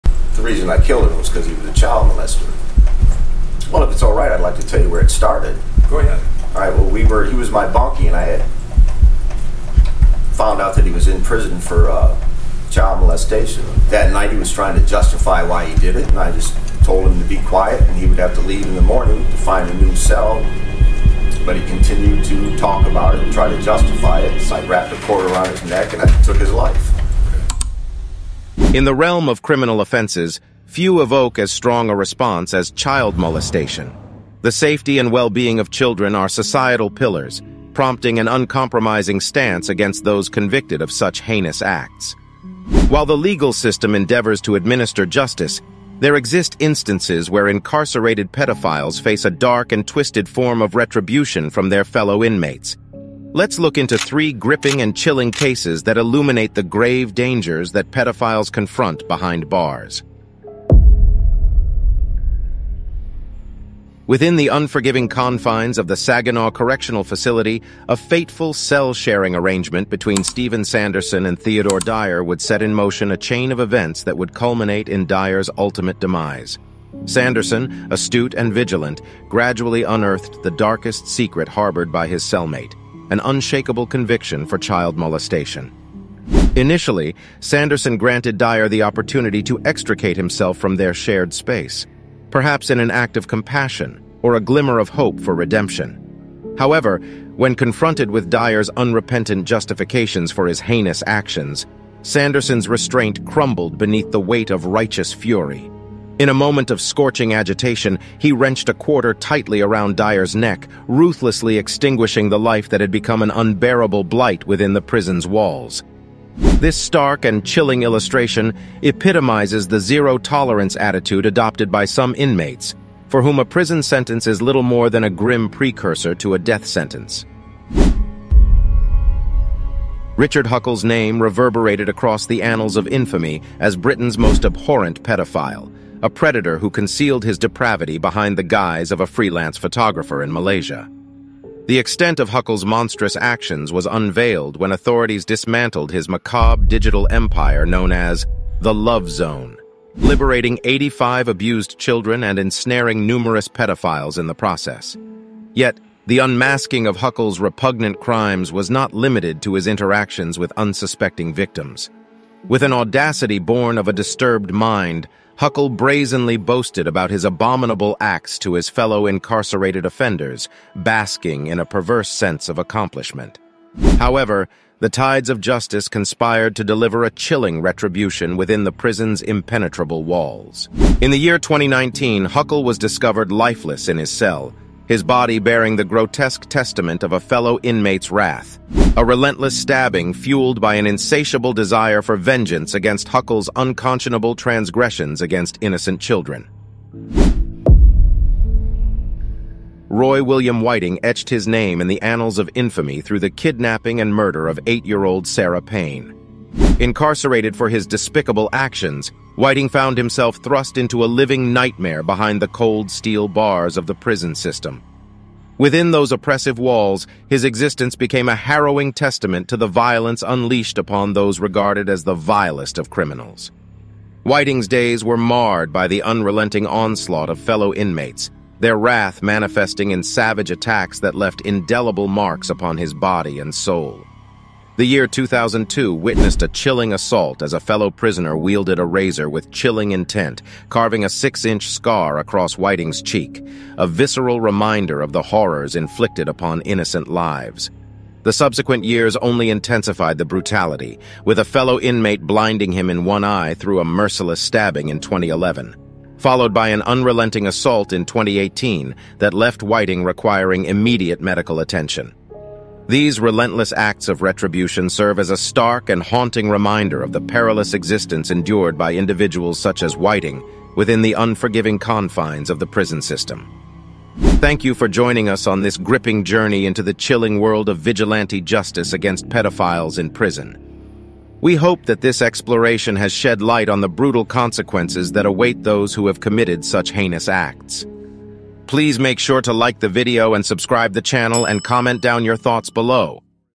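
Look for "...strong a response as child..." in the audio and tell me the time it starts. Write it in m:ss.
0:31.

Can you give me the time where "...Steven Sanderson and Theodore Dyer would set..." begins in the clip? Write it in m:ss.
1:10.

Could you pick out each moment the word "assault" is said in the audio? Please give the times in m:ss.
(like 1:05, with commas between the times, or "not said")
3:56, 4:17.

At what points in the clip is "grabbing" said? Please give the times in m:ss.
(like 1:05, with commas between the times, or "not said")
not said.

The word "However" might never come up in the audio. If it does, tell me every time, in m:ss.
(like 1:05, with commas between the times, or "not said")
1:36, 2:53.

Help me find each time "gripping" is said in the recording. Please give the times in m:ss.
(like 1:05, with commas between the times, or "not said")
0:54, 4:35.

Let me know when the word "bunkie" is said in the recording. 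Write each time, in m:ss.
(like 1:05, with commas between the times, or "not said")
0:07.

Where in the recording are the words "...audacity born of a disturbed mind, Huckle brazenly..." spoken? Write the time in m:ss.
2:42.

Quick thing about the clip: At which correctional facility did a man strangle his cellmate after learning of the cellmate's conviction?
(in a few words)
Saginaw Correctional Facility.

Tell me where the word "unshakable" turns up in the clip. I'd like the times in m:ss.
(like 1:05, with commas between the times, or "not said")
1:23.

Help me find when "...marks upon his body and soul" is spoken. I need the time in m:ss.
3:52.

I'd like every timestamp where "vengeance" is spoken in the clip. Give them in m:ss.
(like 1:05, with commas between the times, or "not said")
3:12.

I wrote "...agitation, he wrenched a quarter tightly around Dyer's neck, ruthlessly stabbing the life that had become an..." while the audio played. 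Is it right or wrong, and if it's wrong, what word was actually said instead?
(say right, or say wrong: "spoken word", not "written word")
wrong: "extinguishing", not "stabbing".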